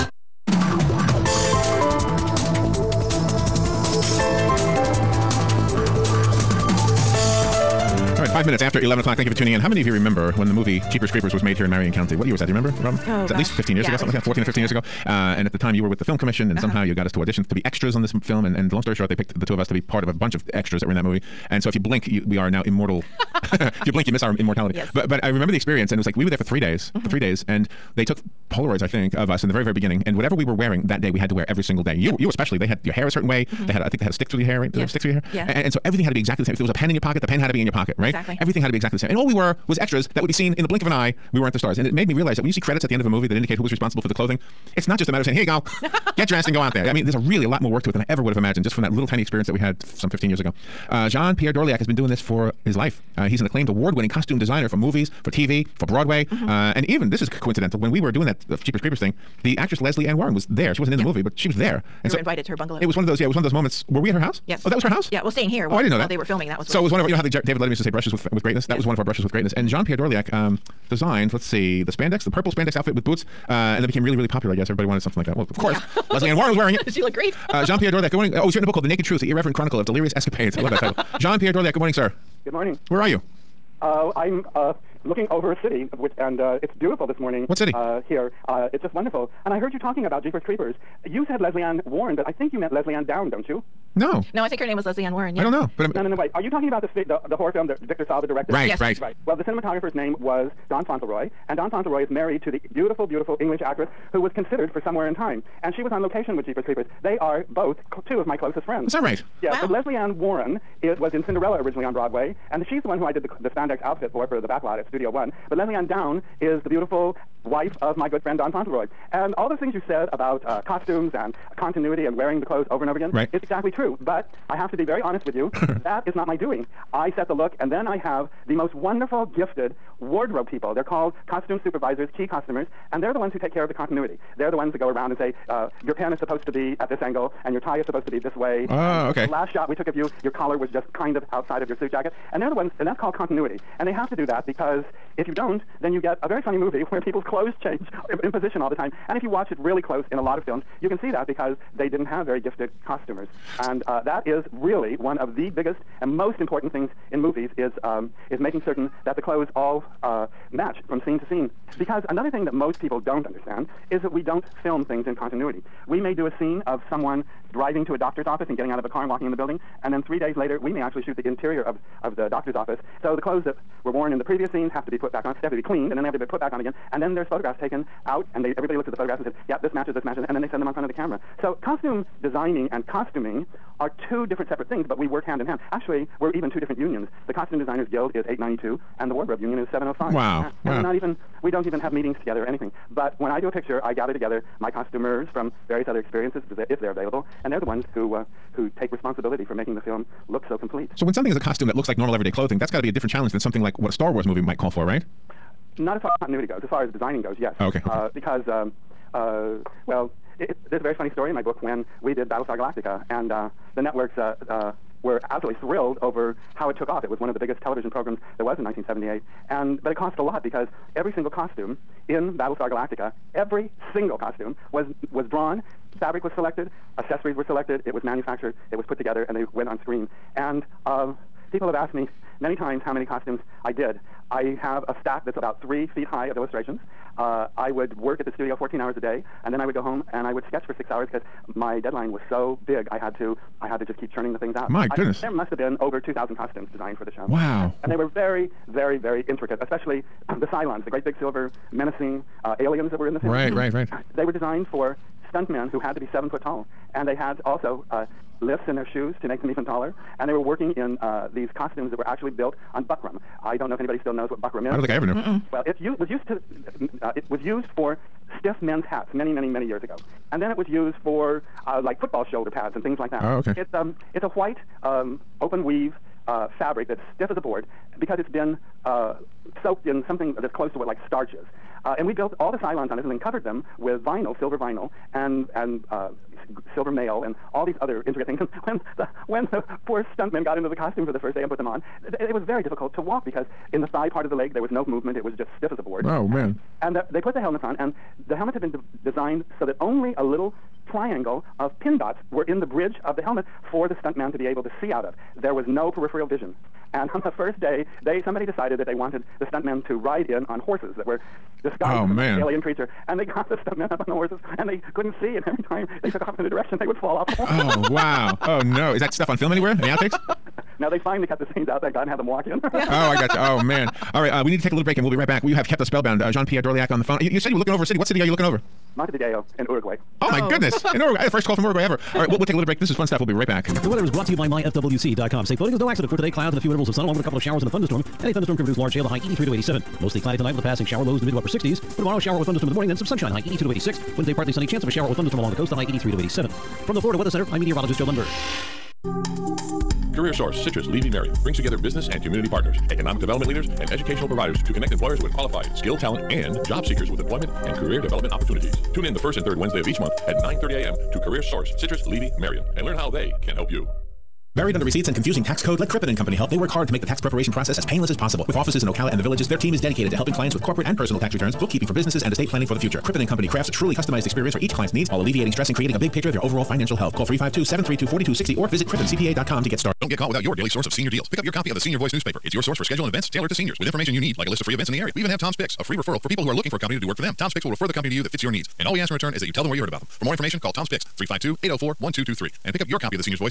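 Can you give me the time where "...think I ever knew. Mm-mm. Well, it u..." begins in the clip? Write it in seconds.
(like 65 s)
264 s.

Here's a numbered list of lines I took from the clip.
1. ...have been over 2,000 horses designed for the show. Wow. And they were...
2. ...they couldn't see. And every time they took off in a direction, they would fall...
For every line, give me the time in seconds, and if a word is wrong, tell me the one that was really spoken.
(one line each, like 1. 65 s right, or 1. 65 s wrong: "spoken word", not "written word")
1. 245 s wrong: "costumes", not "horses"
2. 314 s right.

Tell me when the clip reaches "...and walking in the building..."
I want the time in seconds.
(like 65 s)
169 s.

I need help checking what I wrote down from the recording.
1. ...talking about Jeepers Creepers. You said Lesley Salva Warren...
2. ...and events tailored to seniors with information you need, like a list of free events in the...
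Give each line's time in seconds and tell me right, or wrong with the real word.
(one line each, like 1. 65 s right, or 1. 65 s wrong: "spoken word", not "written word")
1. 89 s wrong: "Ann", not "Salva"
2. 383 s right.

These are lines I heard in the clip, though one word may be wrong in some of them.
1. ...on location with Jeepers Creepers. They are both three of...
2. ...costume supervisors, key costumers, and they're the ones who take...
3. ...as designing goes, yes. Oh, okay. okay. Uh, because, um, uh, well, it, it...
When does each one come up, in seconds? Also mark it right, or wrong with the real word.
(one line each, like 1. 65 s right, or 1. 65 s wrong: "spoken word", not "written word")
1. 105 s wrong: "two", not "three"
2. 131 s right
3. 206 s right.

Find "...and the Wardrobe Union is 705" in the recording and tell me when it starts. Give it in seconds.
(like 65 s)
188 s.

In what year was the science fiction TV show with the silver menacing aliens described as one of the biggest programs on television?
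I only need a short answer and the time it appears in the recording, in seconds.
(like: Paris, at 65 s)
1978, at 218 s.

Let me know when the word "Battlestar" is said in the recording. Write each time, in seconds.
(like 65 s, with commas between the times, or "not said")
212 s, 222 s.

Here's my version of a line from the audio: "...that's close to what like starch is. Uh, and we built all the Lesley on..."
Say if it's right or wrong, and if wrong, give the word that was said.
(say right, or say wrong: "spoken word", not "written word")
wrong: "Cylons", not "Lesley".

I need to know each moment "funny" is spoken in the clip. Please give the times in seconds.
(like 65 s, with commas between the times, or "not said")
146 s, 210 s.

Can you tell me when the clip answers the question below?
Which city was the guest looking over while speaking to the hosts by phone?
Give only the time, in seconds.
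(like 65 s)
328 s.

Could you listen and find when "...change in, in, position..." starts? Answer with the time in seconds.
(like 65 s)
147 s.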